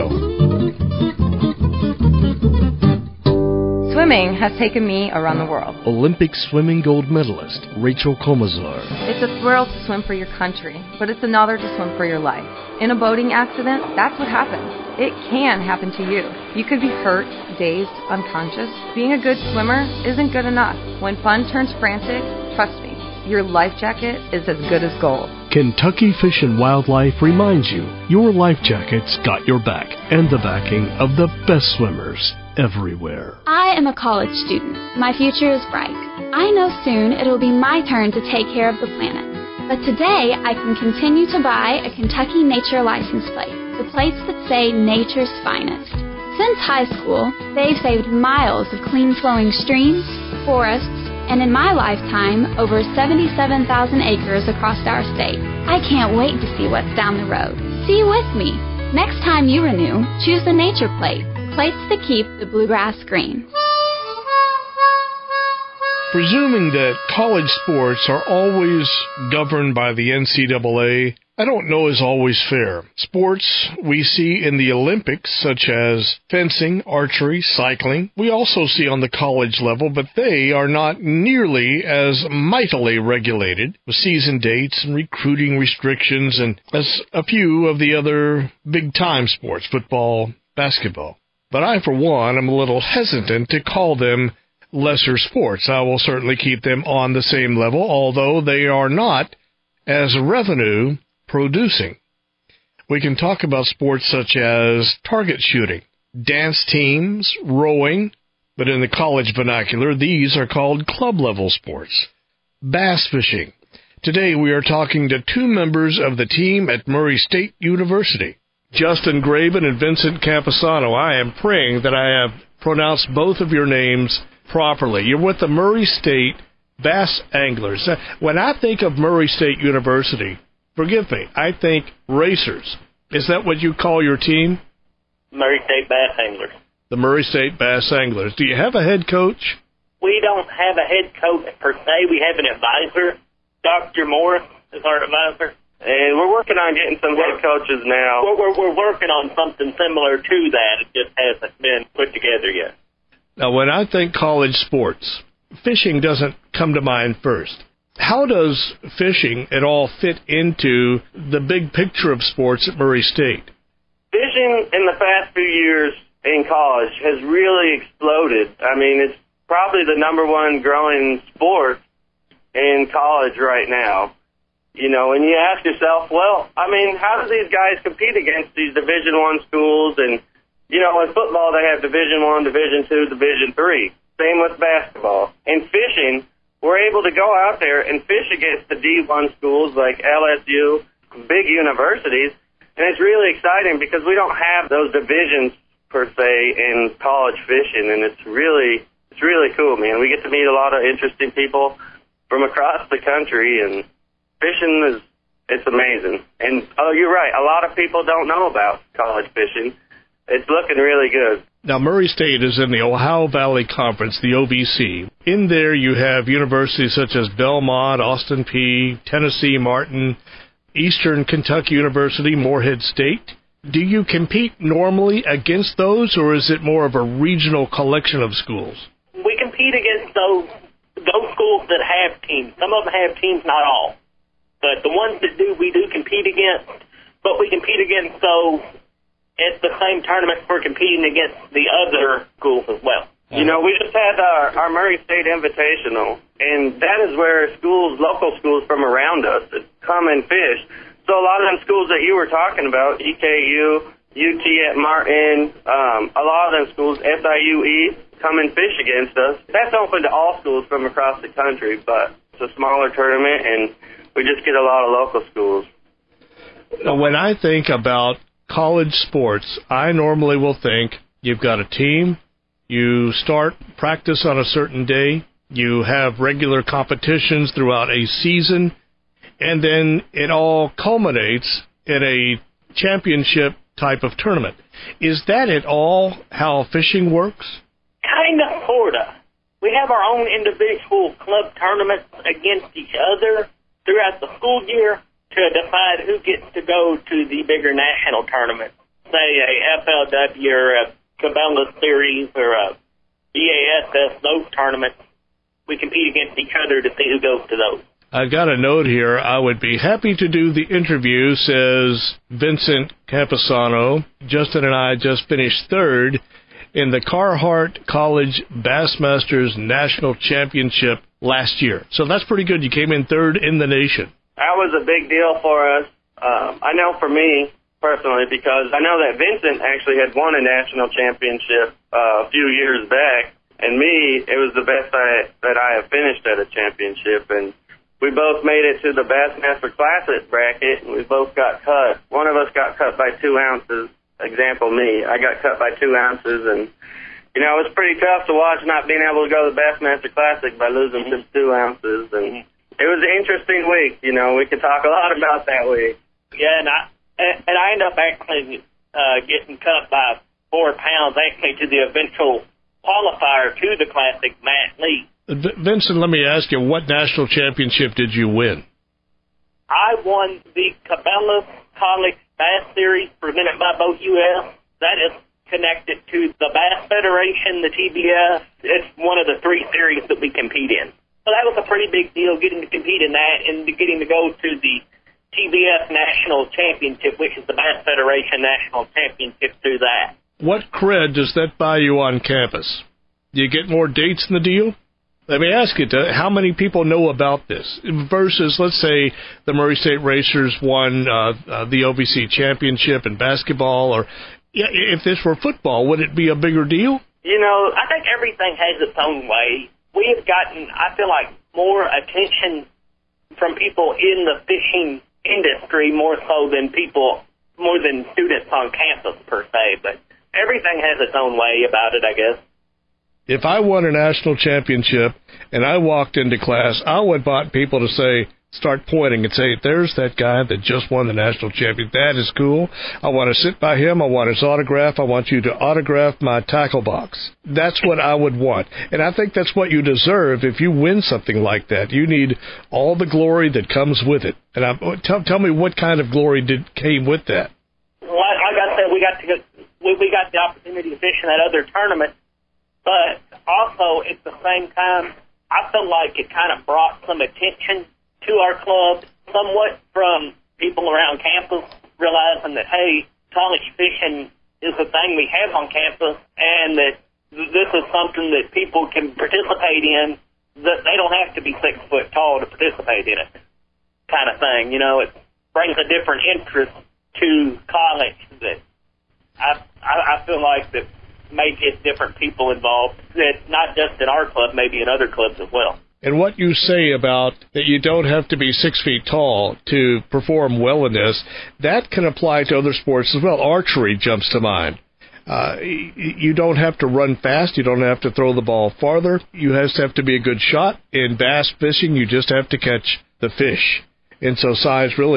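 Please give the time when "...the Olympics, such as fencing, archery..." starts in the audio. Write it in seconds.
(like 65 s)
74 s.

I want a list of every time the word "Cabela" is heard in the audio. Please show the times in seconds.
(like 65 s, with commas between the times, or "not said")
301 s, 370 s.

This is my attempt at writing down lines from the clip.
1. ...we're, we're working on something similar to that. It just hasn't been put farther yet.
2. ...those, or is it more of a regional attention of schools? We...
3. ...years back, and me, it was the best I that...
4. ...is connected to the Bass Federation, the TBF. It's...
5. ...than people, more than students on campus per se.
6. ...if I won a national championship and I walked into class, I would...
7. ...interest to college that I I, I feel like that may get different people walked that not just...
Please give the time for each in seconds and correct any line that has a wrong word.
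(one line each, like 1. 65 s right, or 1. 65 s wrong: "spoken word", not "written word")
1. 148 s wrong: "together", not "farther"
2. 225 s wrong: "collection", not "attention"
3. 332 s right
4. 375 s right
5. 416 s right
6. 423 s right
7. 476 s wrong: "involved", not "walked".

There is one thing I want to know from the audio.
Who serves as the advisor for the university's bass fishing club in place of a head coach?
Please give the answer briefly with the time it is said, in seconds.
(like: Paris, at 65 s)
Dr. Moore, at 143 s.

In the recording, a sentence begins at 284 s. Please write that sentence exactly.
Is that at all how fishing works?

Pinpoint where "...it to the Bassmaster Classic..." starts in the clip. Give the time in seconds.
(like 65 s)
338 s.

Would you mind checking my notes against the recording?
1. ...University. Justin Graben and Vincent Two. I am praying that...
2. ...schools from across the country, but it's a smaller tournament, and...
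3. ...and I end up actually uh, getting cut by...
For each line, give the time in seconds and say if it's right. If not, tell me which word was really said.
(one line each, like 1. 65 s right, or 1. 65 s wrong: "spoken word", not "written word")
1. 117 s wrong: "Campisano", not "Two"
2. 260 s right
3. 357 s right.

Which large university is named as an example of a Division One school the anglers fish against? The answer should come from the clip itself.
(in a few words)
LSU.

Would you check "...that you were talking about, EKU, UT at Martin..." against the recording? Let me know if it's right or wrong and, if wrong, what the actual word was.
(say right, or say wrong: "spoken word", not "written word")
right.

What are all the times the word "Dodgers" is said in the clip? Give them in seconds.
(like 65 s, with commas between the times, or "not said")
not said.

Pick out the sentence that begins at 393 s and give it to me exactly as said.
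Do you get more dates in the deal?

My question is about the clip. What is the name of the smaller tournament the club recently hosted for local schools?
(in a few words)
Murray State Invitational.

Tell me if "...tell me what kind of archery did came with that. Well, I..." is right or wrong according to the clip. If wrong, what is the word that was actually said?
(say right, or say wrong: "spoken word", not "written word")
wrong: "glory", not "archery".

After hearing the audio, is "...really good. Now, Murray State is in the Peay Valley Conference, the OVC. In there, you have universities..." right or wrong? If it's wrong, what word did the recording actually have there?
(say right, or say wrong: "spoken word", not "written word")
wrong: "Ohio", not "Peay".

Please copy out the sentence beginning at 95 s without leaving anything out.
I will certainly keep them on the same level, although they are not as revenue producing.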